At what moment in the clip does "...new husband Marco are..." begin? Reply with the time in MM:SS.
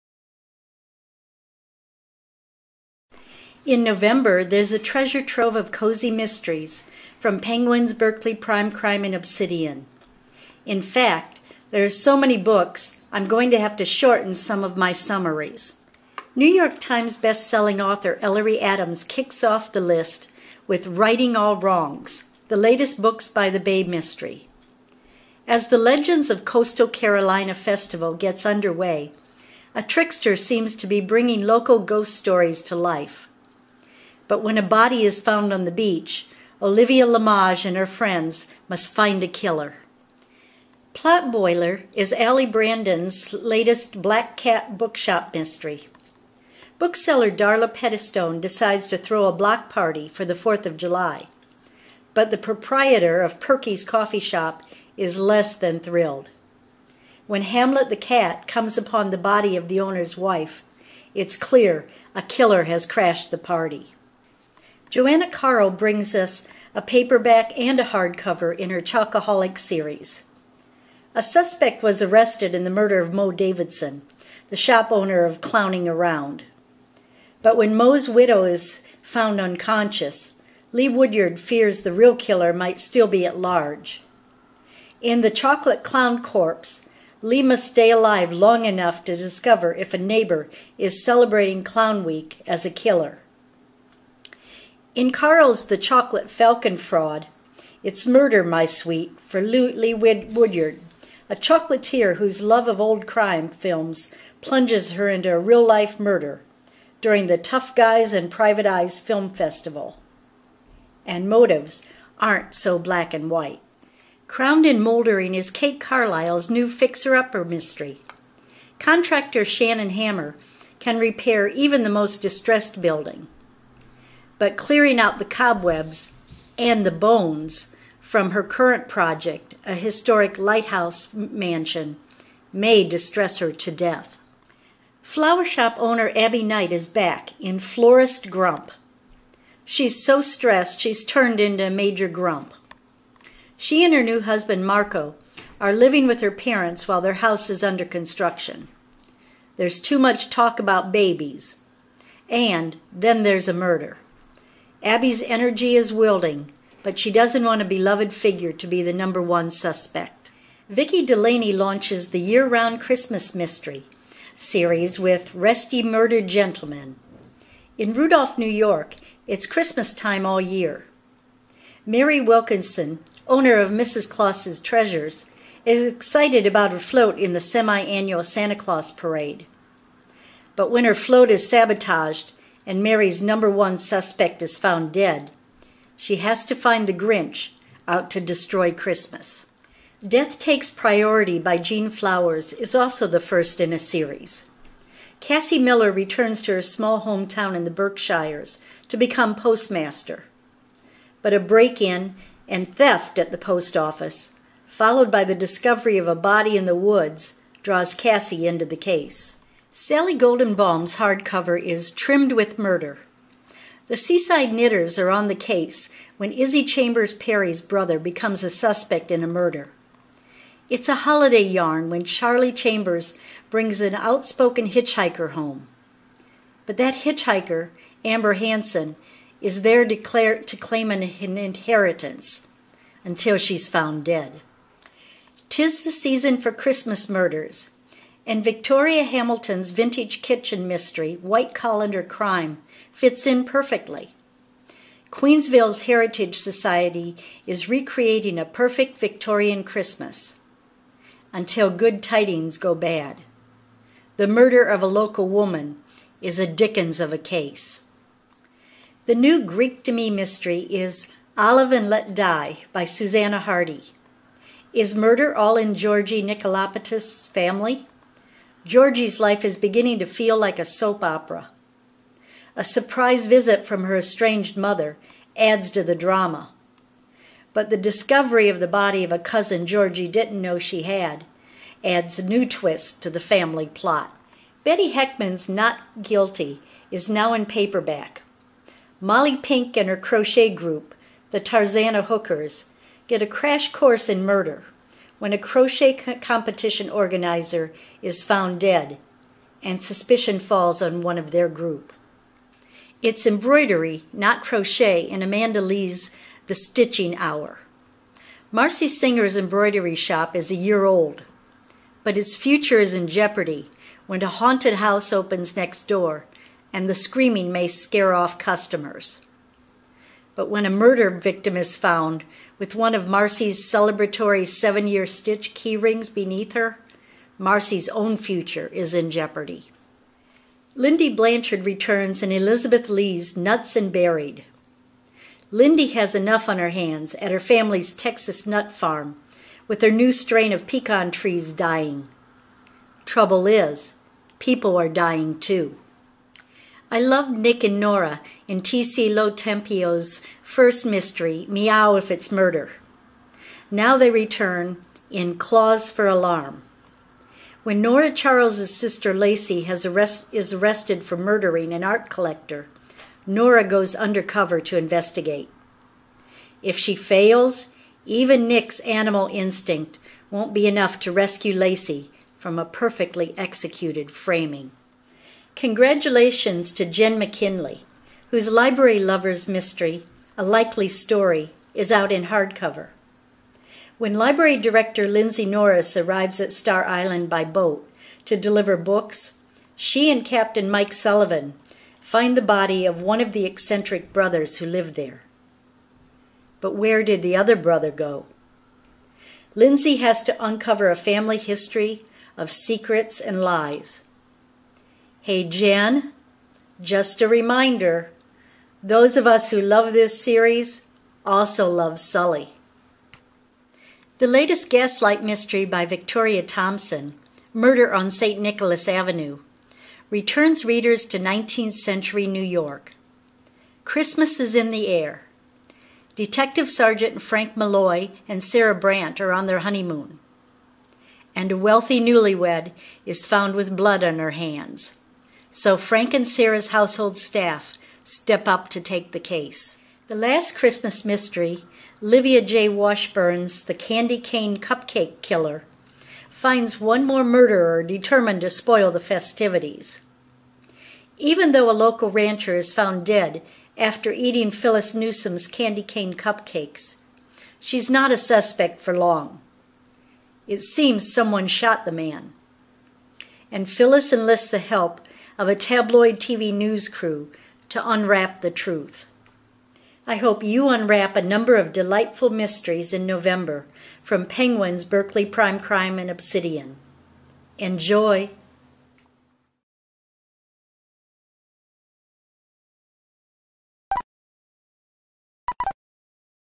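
02:24.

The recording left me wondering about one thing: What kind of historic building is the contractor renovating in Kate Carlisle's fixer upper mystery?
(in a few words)
Lighthouse mansion.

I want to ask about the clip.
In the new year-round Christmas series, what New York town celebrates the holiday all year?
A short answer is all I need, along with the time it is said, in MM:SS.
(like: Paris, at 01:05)
Rudolph, at 02:47.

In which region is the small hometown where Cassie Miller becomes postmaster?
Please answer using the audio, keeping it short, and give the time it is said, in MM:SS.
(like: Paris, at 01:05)
The Berkshires, at 03:17.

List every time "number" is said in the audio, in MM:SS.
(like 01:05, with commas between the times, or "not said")
02:38, 03:03, 07:51.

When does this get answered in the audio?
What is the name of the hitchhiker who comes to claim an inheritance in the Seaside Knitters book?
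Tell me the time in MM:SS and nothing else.
03:48.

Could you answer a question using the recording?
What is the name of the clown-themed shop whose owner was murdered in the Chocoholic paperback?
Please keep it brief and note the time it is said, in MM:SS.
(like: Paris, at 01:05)
Clowning Around, at 01:15.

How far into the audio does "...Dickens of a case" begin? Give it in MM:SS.
04:16.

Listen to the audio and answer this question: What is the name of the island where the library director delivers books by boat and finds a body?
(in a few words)
Star Island.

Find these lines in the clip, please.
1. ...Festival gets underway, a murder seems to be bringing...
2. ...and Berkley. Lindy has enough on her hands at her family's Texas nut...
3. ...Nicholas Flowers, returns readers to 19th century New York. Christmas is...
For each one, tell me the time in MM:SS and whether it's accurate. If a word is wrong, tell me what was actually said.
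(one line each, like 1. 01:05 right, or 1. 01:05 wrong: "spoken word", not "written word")
1. 00:27 wrong: "trickster", not "murder"
2. 05:33 wrong: "Buried", not "Berkley"
3. 06:58 wrong: "Avenue", not "Flowers".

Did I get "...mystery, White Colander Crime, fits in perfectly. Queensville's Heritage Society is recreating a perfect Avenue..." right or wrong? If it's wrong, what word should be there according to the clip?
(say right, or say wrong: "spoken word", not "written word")
wrong: "Victorian", not "Avenue".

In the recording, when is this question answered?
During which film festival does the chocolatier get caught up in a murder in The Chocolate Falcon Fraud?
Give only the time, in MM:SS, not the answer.
01:47.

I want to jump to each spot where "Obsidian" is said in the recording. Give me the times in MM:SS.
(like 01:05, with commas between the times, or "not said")
00:09, 07:56.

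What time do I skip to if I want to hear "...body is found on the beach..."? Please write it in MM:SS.
00:34.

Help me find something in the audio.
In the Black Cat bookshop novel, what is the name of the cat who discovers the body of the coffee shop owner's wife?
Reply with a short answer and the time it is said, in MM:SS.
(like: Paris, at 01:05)
Hamlet, at 00:57.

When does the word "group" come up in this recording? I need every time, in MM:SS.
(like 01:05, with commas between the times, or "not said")
04:50, 05:01.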